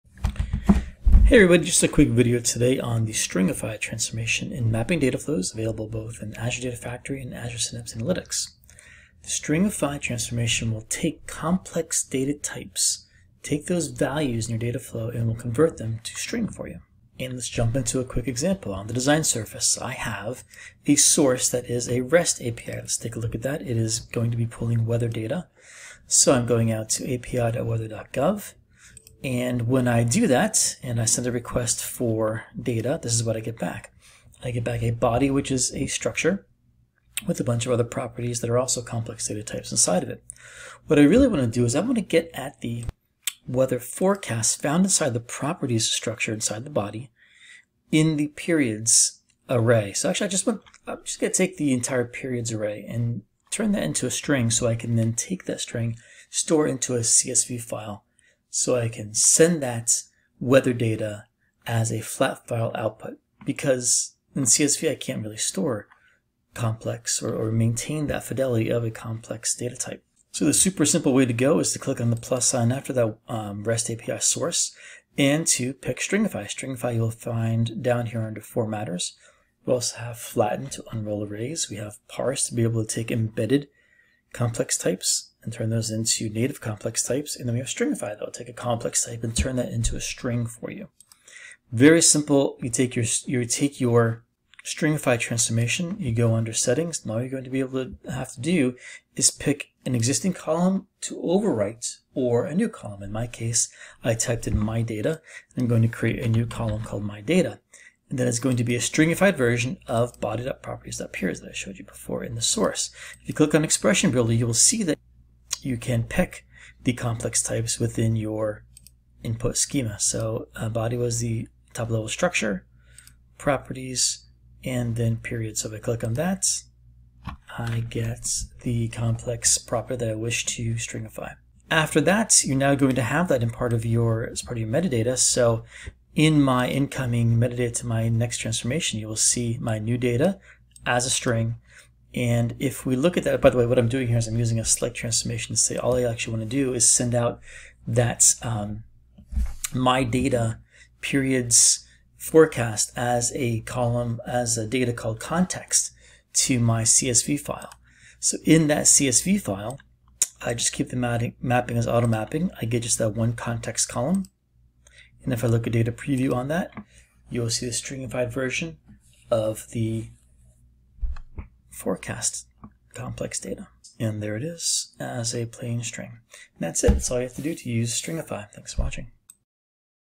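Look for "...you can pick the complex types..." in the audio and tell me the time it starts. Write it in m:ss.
1:55.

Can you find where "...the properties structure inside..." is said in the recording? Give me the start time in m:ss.
0:45.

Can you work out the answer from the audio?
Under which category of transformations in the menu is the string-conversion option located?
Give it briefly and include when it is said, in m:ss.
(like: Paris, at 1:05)
formatters, at 1:18.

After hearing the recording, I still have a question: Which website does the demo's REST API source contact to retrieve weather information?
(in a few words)
api.weather.gov.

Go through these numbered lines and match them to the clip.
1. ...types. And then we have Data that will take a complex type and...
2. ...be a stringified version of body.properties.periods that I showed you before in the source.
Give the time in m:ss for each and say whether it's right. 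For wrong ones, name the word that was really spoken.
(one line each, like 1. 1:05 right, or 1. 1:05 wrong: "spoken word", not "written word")
1. 1:27 wrong: "Stringify", not "Data"
2. 1:48 right.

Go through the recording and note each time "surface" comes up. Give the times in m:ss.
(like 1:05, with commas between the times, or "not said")
0:19.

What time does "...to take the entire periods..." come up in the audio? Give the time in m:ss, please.
0:51.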